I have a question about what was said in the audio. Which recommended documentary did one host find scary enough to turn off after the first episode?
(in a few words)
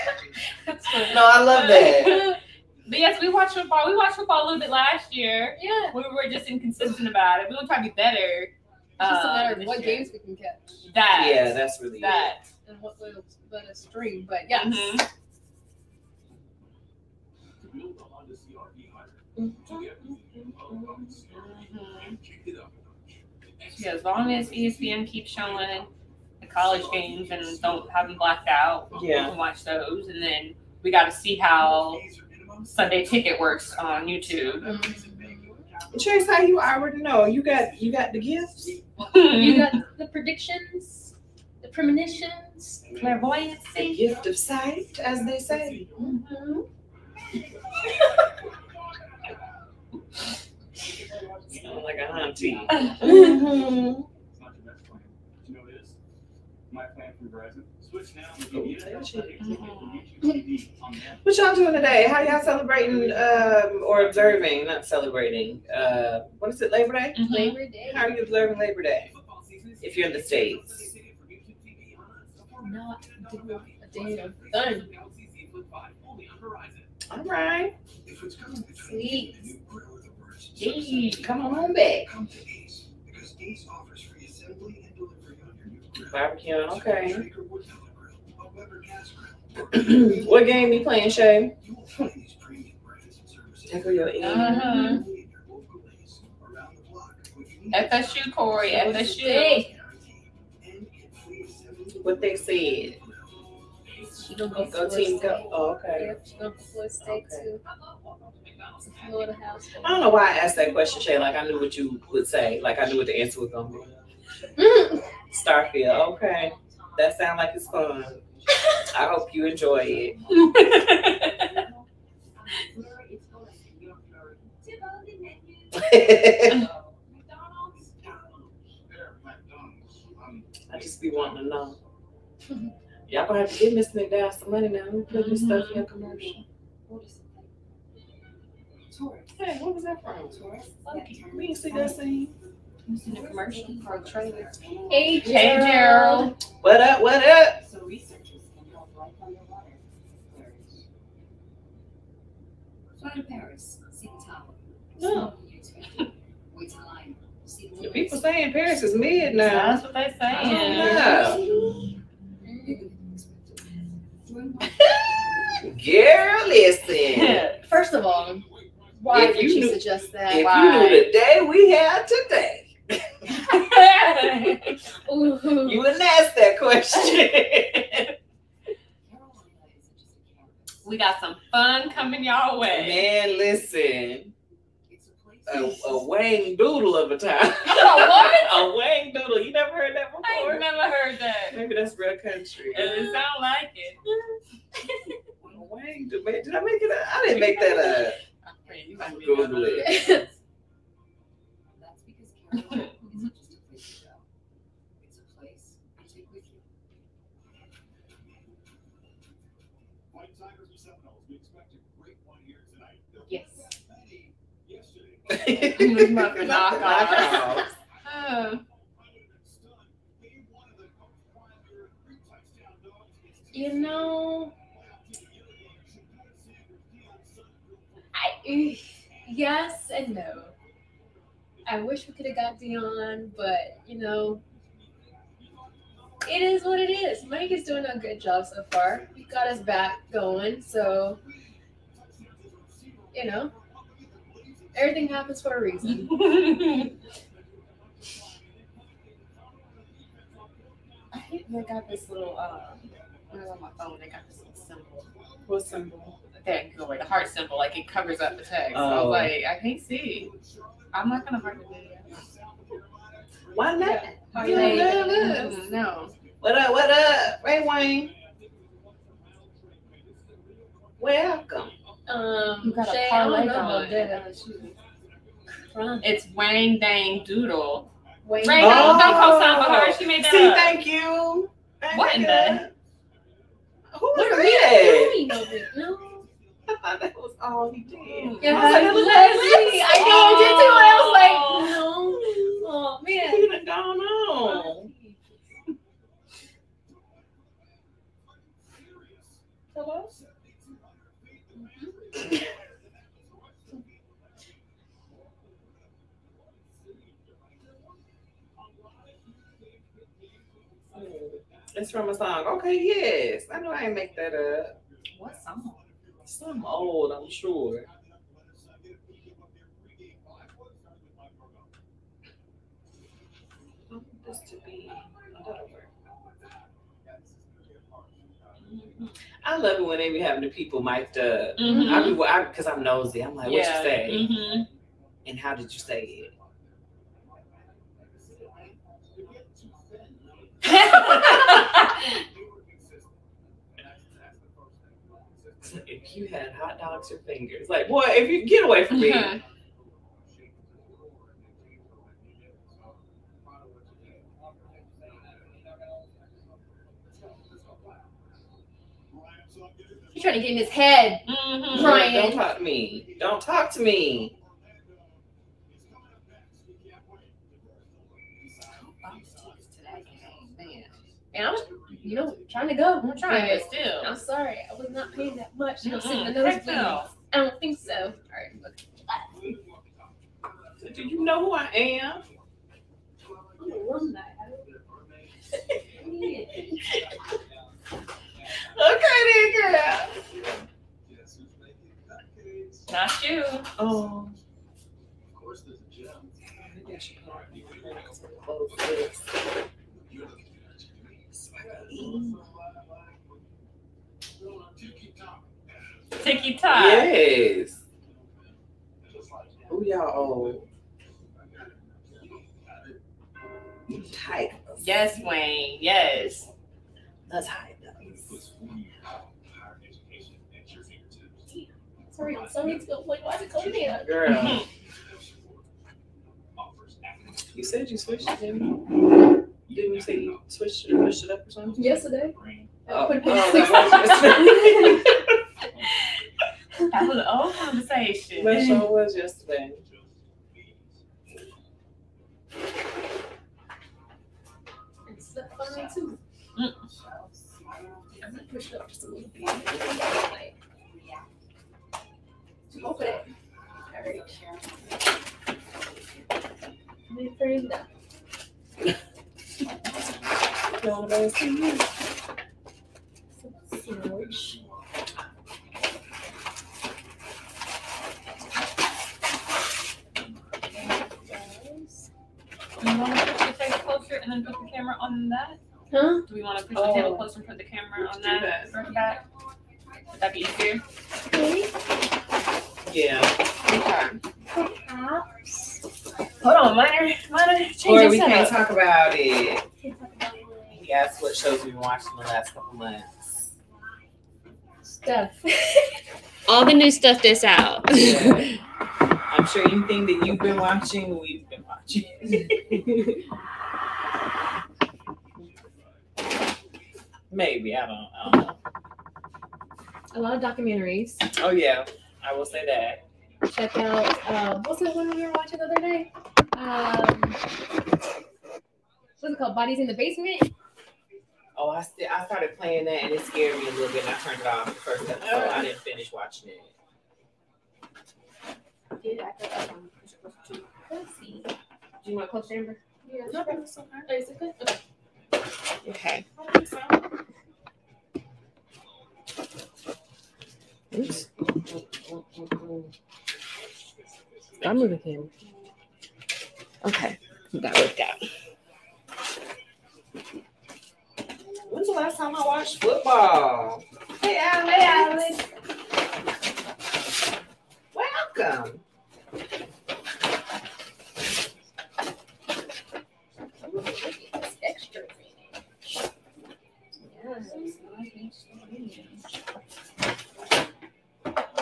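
Bodies in the Basement.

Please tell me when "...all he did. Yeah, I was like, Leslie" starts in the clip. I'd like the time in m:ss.
4:47.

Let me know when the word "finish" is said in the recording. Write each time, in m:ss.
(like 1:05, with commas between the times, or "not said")
8:45.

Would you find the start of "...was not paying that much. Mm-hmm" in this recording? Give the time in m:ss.
6:14.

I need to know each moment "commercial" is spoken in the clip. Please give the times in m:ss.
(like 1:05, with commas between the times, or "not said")
2:15, 2:23.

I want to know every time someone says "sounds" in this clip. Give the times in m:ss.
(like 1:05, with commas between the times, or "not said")
1:57, 3:13.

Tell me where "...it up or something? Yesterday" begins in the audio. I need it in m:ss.
7:10.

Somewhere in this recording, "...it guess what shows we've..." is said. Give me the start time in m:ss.
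8:09.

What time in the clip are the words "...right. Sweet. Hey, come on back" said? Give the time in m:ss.
1:17.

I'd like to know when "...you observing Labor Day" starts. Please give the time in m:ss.
1:08.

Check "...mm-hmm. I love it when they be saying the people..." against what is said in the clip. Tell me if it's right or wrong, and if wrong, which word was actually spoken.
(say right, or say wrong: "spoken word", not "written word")
wrong: "having", not "saying".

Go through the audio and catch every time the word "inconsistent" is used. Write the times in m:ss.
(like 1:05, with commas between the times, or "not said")
0:06.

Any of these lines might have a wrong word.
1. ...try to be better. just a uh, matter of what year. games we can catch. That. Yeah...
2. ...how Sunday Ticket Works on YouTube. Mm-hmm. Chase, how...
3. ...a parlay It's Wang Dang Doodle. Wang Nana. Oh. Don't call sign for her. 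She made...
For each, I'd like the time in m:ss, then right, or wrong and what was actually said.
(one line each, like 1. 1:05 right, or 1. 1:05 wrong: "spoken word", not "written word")
1. 0:07 right
2. 0:31 right
3. 4:33 wrong: "Dang", not "Nana".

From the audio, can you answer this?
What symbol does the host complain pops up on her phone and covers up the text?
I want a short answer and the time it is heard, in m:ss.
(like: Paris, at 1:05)
heart symbol, at 4:16.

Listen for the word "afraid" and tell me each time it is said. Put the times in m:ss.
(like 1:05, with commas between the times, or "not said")
7:37.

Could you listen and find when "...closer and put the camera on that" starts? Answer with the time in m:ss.
7:57.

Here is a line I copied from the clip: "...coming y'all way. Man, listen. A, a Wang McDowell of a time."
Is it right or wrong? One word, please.
wrong.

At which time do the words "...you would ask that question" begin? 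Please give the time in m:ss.
2:55.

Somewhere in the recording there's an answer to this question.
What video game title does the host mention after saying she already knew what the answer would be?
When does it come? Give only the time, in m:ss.
1:55.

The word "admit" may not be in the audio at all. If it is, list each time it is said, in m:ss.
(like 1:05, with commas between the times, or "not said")
not said.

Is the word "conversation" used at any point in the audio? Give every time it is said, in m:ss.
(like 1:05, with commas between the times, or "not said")
7:17.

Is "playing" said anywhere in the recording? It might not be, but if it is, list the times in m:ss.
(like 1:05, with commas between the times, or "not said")
1:30, 8:42.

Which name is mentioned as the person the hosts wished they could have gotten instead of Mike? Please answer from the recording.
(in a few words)
Dion.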